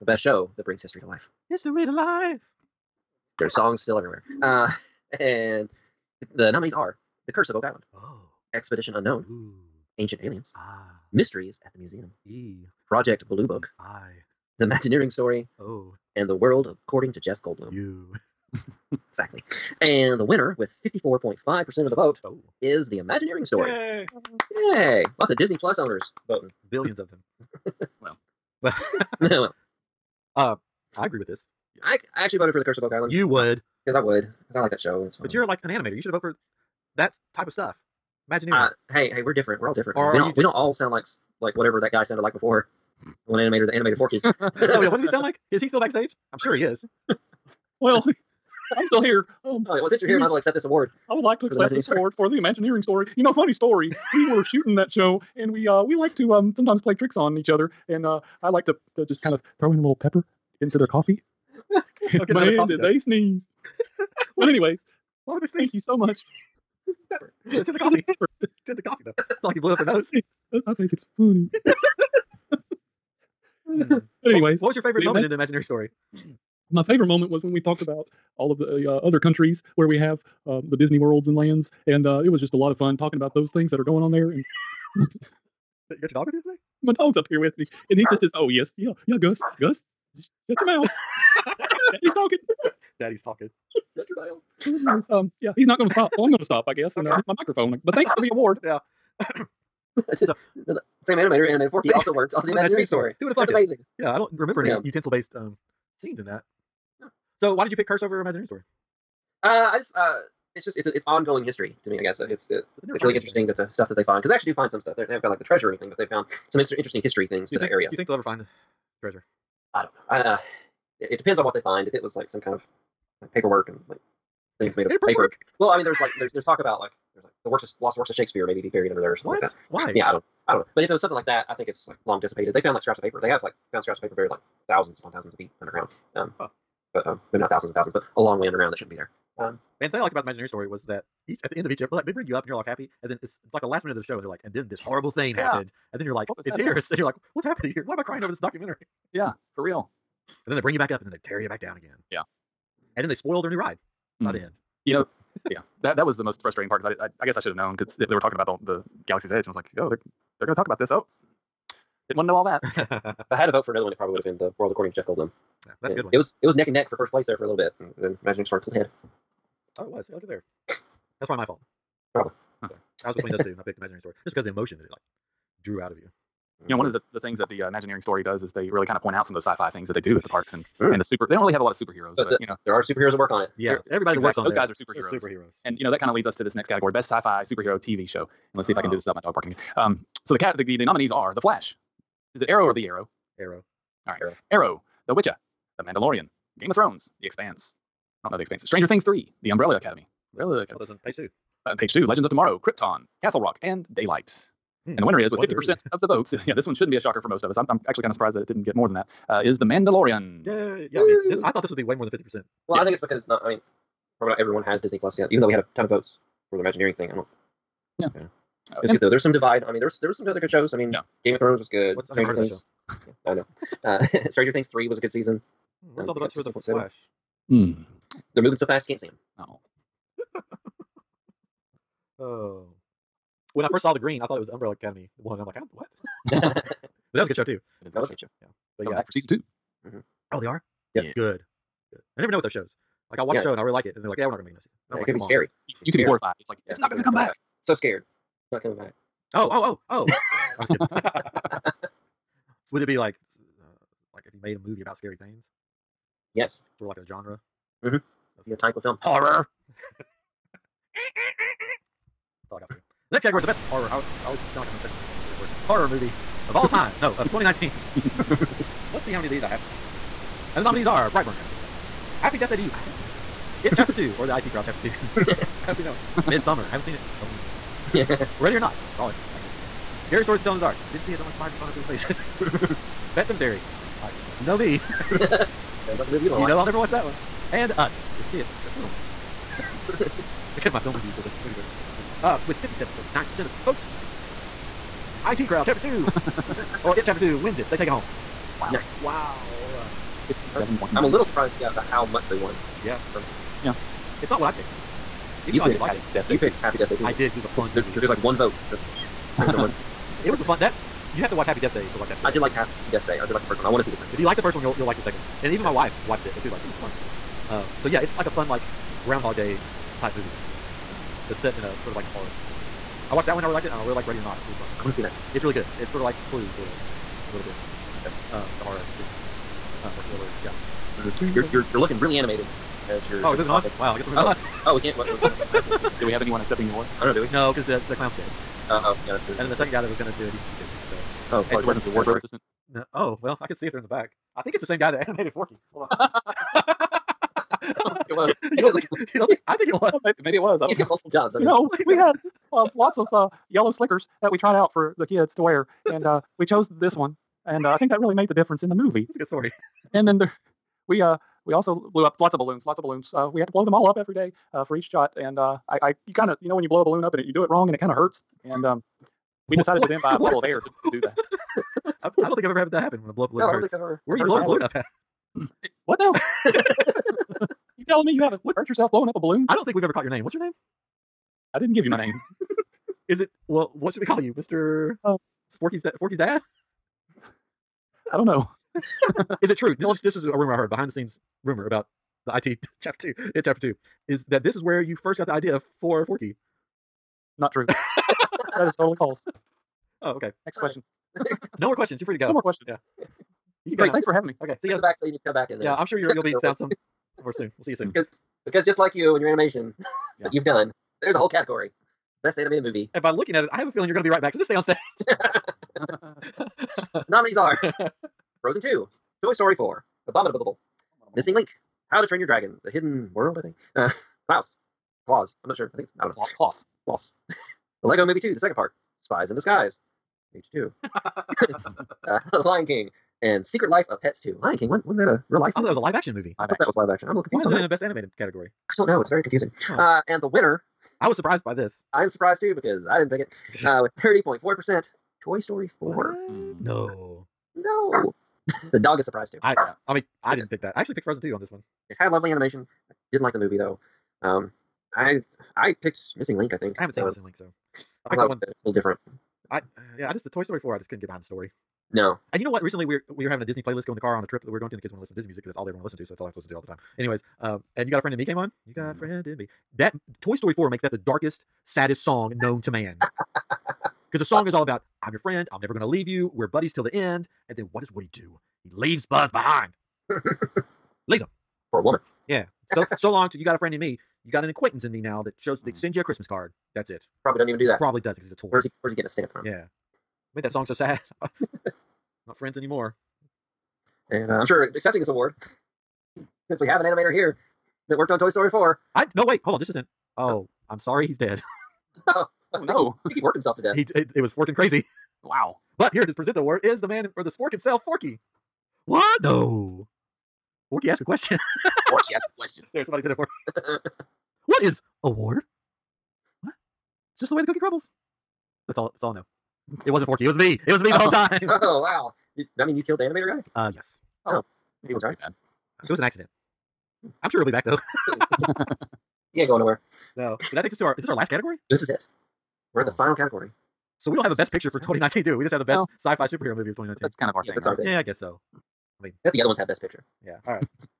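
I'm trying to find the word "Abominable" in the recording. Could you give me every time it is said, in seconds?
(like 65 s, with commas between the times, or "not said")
420 s.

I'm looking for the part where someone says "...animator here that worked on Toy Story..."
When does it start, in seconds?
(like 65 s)
496 s.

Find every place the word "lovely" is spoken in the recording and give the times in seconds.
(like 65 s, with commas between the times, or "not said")
452 s.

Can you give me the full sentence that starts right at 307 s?
Because there's like one vote for.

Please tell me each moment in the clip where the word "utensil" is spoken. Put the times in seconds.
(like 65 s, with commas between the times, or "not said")
104 s.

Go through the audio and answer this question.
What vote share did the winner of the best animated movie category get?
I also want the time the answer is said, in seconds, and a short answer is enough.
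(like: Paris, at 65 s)
30.4%, at 444 s.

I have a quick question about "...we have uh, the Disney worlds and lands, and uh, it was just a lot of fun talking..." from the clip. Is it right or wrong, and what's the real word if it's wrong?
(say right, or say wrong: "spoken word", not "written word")
right.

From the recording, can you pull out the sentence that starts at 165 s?
Yeah, that's and a good one.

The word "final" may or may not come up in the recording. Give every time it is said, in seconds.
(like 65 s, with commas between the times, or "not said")
532 s.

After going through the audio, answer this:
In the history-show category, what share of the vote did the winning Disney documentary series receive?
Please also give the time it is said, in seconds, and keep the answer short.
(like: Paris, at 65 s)
54.5%, at 20 s.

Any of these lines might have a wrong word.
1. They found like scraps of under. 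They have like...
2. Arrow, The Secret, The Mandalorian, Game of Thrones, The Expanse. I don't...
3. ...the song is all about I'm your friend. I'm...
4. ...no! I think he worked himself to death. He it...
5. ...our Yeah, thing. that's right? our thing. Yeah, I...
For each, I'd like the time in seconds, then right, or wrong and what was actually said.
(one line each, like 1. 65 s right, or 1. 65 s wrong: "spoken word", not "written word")
1. 132 s wrong: "paper", not "under"
2. 194 s wrong: "Witcher", not "Secret"
3. 474 s right
4. 502 s right
5. 537 s right.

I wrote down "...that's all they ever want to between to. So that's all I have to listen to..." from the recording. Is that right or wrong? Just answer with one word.
wrong.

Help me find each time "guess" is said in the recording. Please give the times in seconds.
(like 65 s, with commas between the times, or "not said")
96 s, 112 s, 157 s, 333 s, 538 s.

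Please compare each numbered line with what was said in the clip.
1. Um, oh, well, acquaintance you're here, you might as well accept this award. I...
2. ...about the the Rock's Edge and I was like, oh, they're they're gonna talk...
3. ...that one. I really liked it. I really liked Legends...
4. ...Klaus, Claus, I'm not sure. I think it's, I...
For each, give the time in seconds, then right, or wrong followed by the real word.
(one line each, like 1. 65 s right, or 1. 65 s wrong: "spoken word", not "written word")
1. 49 s wrong: "since", not "acquaintance"
2. 158 s wrong: "Galaxy", not "Rock"
3. 323 s wrong: "Ready", not "Legends"
4. 424 s right.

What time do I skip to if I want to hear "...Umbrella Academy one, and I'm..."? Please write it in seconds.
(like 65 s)
234 s.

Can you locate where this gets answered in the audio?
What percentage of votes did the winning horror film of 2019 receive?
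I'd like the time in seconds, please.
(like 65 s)
292 s.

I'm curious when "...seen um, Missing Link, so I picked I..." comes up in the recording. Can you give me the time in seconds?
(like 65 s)
456 s.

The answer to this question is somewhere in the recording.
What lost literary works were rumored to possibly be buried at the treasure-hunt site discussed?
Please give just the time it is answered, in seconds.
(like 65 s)
127 s.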